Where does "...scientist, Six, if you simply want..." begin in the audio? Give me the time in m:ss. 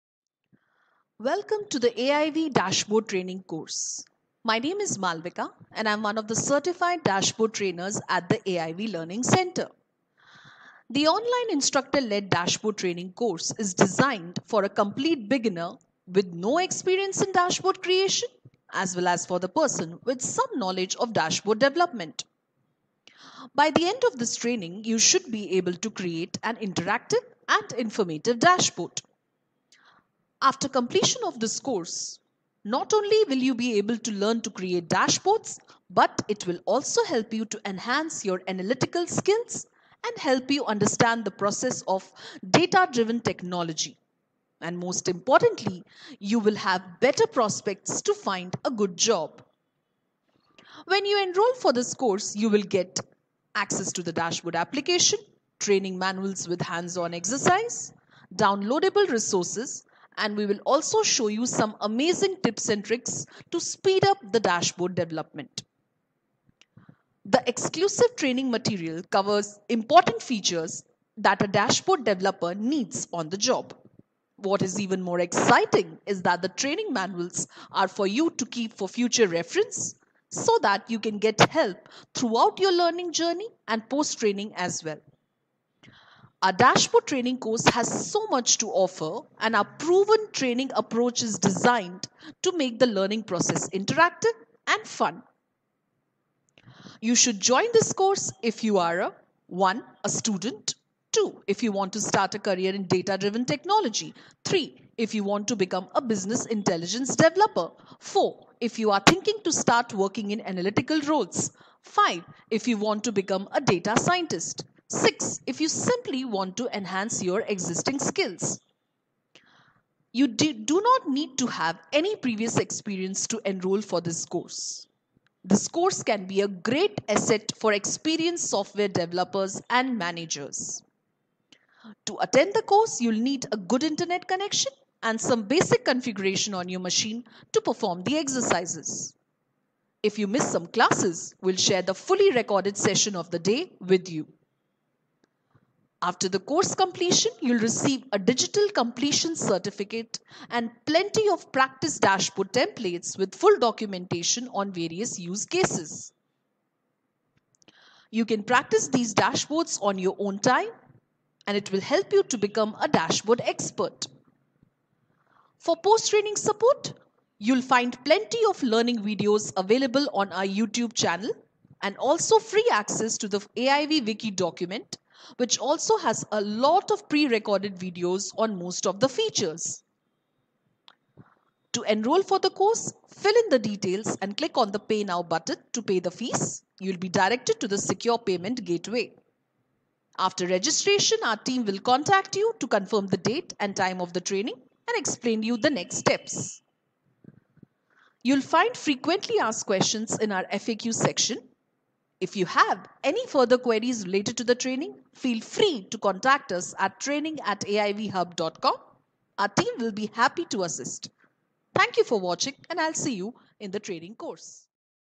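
1:53.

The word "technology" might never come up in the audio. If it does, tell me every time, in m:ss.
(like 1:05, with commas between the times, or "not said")
0:43, 1:43.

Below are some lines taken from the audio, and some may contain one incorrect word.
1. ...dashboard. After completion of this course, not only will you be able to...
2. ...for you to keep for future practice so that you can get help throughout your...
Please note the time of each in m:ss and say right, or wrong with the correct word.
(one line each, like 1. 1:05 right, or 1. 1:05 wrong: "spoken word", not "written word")
1. 0:28 right
2. 1:17 wrong: "reference", not "practice".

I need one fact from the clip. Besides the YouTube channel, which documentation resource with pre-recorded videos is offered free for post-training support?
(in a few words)
AIV Wiki.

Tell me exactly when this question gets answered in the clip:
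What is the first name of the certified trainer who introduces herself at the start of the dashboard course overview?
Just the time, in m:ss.
0:04.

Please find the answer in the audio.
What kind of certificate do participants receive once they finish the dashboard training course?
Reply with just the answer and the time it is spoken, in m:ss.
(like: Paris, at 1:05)
digital completion certificate, at 2:28.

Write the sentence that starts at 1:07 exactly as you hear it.
The exclusive training material covers important features that a dashboard developer needs on the job.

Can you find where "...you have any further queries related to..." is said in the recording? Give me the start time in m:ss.
3:22.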